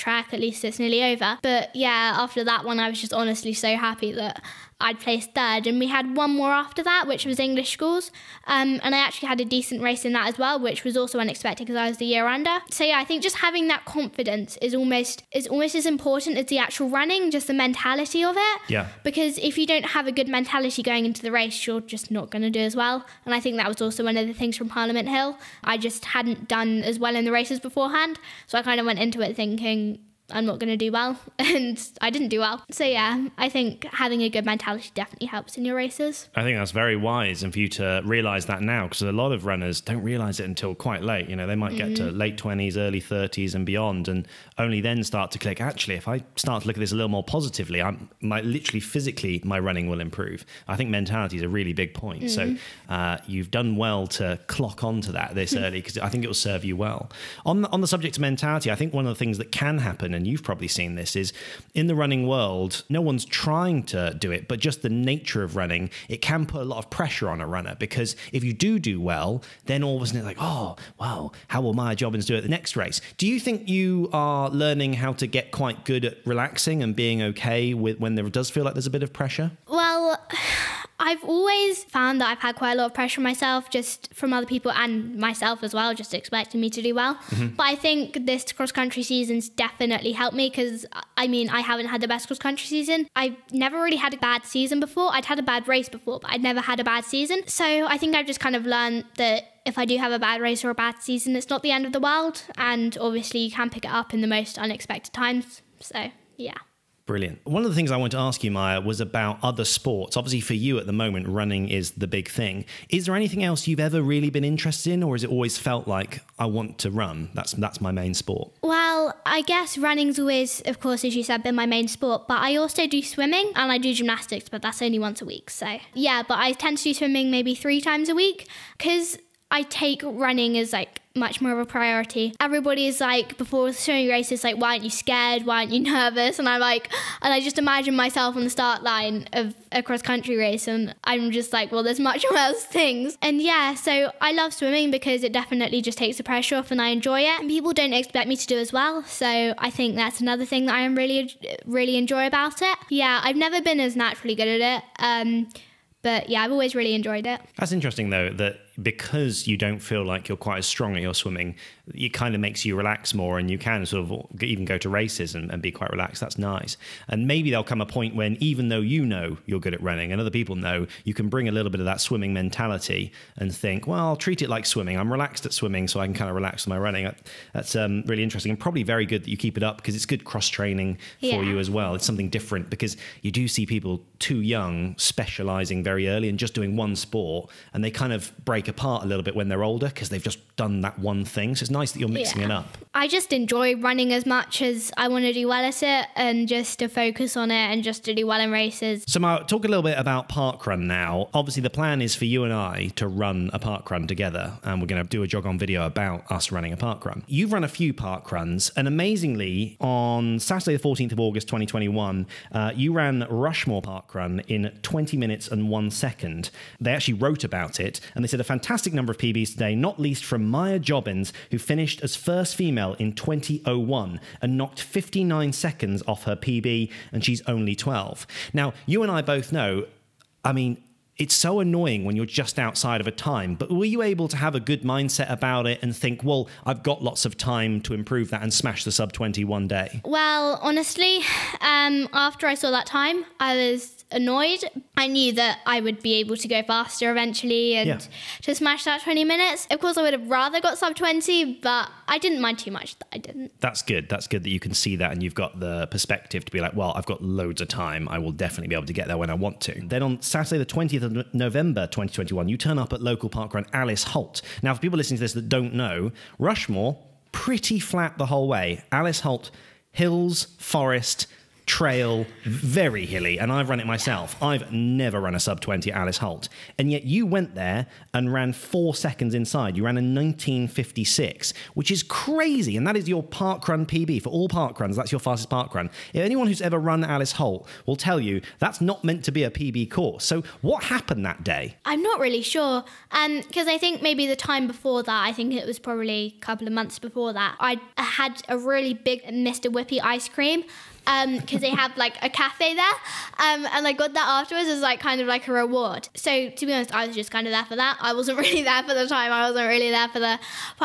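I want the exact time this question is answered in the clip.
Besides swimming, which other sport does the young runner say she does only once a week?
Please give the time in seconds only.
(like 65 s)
123 s.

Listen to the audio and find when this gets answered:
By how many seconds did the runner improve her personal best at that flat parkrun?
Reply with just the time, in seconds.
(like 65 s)
224 s.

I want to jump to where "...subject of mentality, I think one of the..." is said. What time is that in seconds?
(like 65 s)
57 s.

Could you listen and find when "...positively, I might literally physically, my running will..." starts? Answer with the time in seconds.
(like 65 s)
47 s.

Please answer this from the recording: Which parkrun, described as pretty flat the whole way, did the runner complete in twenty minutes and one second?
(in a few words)
Rushmoor Parkrun.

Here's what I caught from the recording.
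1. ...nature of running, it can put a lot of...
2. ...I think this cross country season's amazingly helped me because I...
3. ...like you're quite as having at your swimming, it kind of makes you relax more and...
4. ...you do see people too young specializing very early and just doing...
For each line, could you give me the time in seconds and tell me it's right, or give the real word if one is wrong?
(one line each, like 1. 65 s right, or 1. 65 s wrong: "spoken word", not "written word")
1. 64 s right
2. 87 s wrong: "definitely", not "amazingly"
3. 160 s wrong: "strong", not "having"
4. 183 s right.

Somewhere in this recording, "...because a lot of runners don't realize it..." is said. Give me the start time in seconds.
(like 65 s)
38 s.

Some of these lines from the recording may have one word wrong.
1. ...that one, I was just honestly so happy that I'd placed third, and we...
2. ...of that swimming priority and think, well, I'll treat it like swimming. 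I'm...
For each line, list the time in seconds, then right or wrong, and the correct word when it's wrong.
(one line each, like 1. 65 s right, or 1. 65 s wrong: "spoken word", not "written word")
1. 2 s right
2. 171 s wrong: "mentality", not "priority".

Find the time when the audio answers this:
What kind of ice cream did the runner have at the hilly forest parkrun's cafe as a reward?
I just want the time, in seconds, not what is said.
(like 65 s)
299 s.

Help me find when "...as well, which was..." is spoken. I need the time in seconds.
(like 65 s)
10 s.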